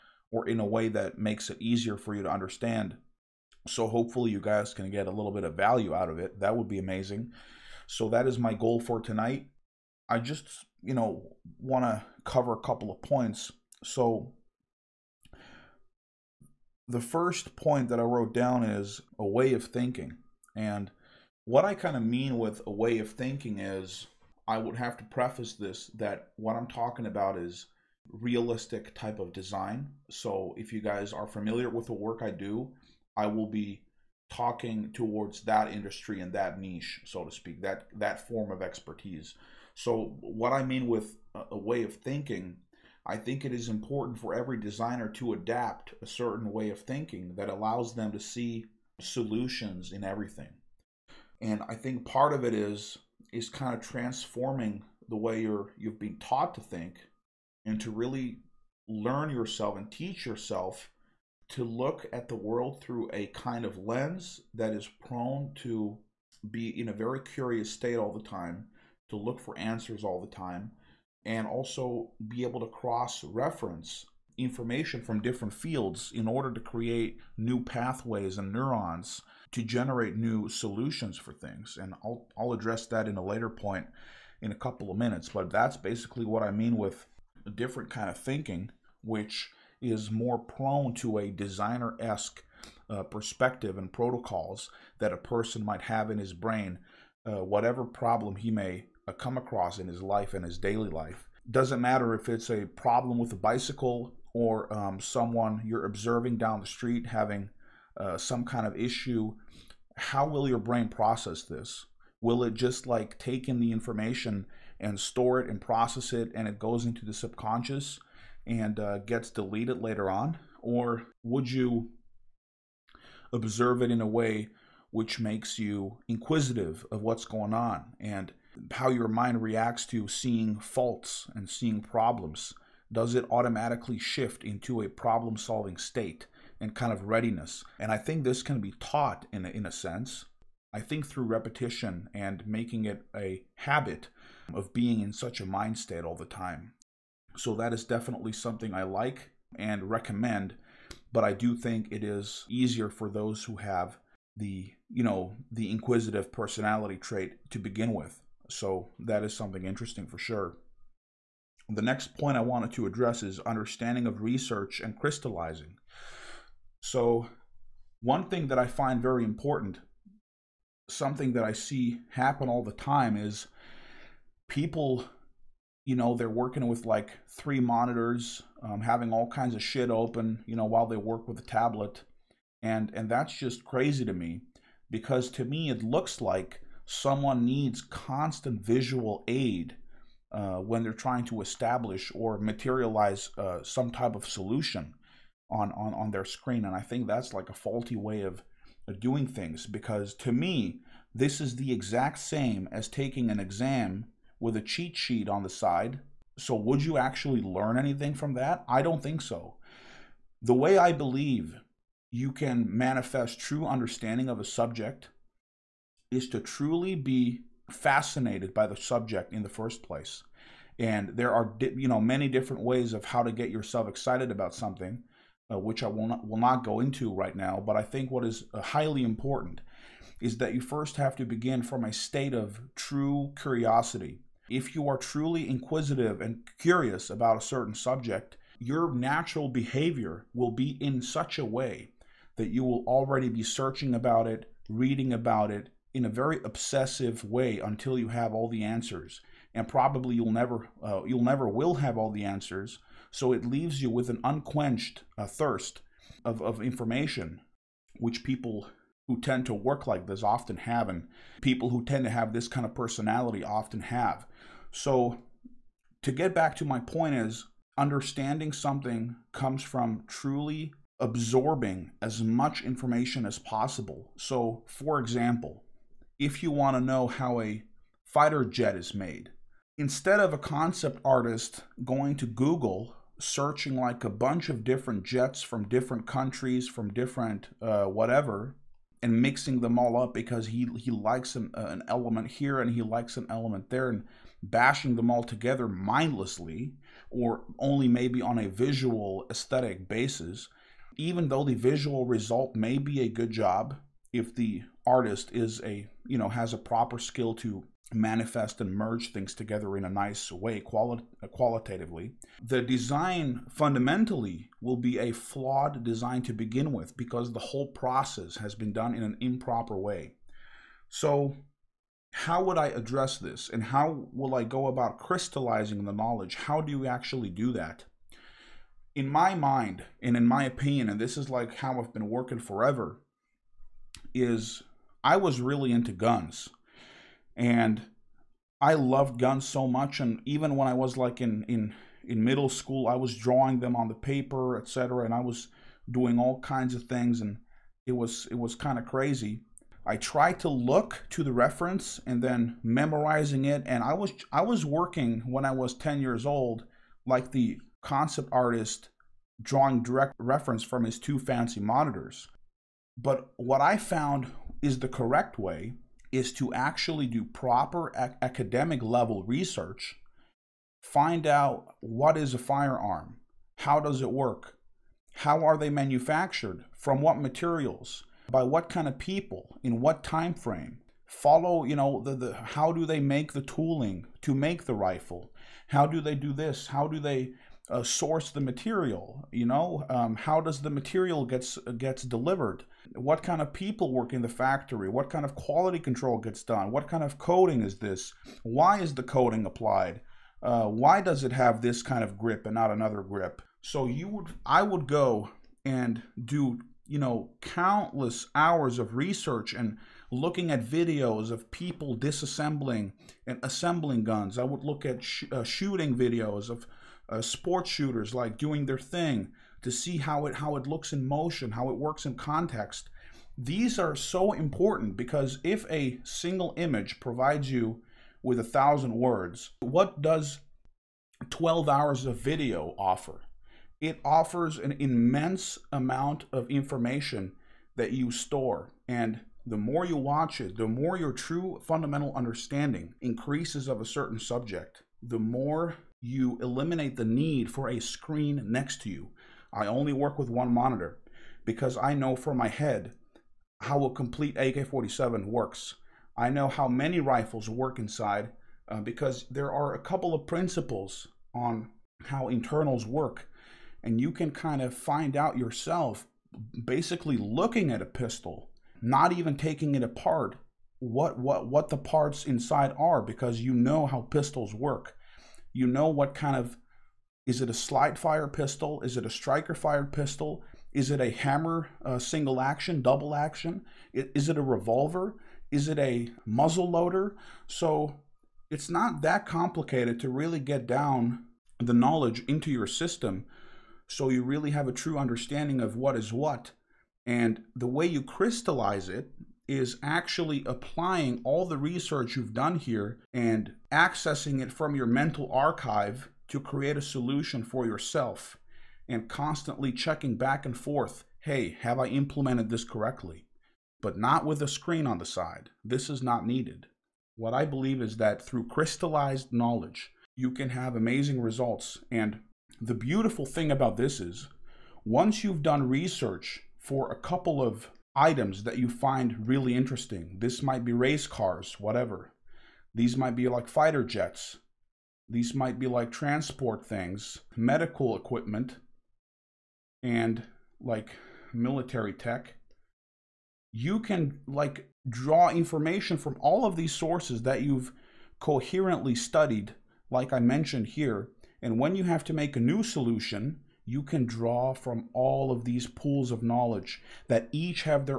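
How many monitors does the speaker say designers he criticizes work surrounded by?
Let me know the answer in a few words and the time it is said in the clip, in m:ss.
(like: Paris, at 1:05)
3, at 2:57.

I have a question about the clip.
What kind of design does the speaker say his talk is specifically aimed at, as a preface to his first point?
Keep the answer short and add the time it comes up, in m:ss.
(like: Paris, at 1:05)
realistic type of design, at 0:28.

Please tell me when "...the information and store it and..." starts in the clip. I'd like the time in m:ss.
1:53.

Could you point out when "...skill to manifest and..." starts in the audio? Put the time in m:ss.
5:06.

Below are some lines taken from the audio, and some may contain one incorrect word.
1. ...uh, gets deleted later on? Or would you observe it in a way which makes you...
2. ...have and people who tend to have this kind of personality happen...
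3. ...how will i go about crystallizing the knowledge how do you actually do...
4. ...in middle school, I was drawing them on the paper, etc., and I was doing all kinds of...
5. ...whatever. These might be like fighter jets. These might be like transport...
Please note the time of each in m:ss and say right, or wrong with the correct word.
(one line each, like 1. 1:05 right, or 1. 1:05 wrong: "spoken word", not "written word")
1. 1:58 right
2. 4:20 wrong: "often", not "happen"
3. 5:23 right
4. 5:42 right
5. 8:51 right.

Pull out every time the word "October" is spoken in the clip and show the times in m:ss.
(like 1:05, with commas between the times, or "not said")
not said.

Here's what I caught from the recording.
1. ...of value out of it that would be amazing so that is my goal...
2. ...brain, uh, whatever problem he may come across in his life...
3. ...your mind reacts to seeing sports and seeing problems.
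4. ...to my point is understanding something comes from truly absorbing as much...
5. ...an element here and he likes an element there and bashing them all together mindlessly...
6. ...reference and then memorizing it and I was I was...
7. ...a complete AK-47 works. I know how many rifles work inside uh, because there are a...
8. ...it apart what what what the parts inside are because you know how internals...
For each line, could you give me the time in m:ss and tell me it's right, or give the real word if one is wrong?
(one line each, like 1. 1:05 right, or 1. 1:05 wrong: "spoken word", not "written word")
1. 0:05 right
2. 1:36 right
3. 2:08 wrong: "faults", not "sports"
4. 4:26 right
5. 4:51 right
6. 5:51 right
7. 7:33 right
8. 7:49 wrong: "pistols", not "internals".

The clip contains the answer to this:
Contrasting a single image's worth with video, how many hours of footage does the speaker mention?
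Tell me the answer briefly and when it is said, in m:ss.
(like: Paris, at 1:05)
12, at 7:11.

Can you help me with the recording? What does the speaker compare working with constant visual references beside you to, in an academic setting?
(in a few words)
an exam with a cheat sheet.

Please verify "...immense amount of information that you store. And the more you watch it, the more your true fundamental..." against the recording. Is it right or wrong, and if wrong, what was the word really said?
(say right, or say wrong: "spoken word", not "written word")
right.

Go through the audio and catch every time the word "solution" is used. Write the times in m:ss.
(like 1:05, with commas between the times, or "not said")
0:49, 1:20, 3:14, 8:26, 9:12.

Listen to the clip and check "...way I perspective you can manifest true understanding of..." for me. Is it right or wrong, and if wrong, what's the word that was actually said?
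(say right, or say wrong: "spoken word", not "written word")
wrong: "believe", not "perspective".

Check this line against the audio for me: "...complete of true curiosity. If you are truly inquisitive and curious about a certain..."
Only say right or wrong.
wrong.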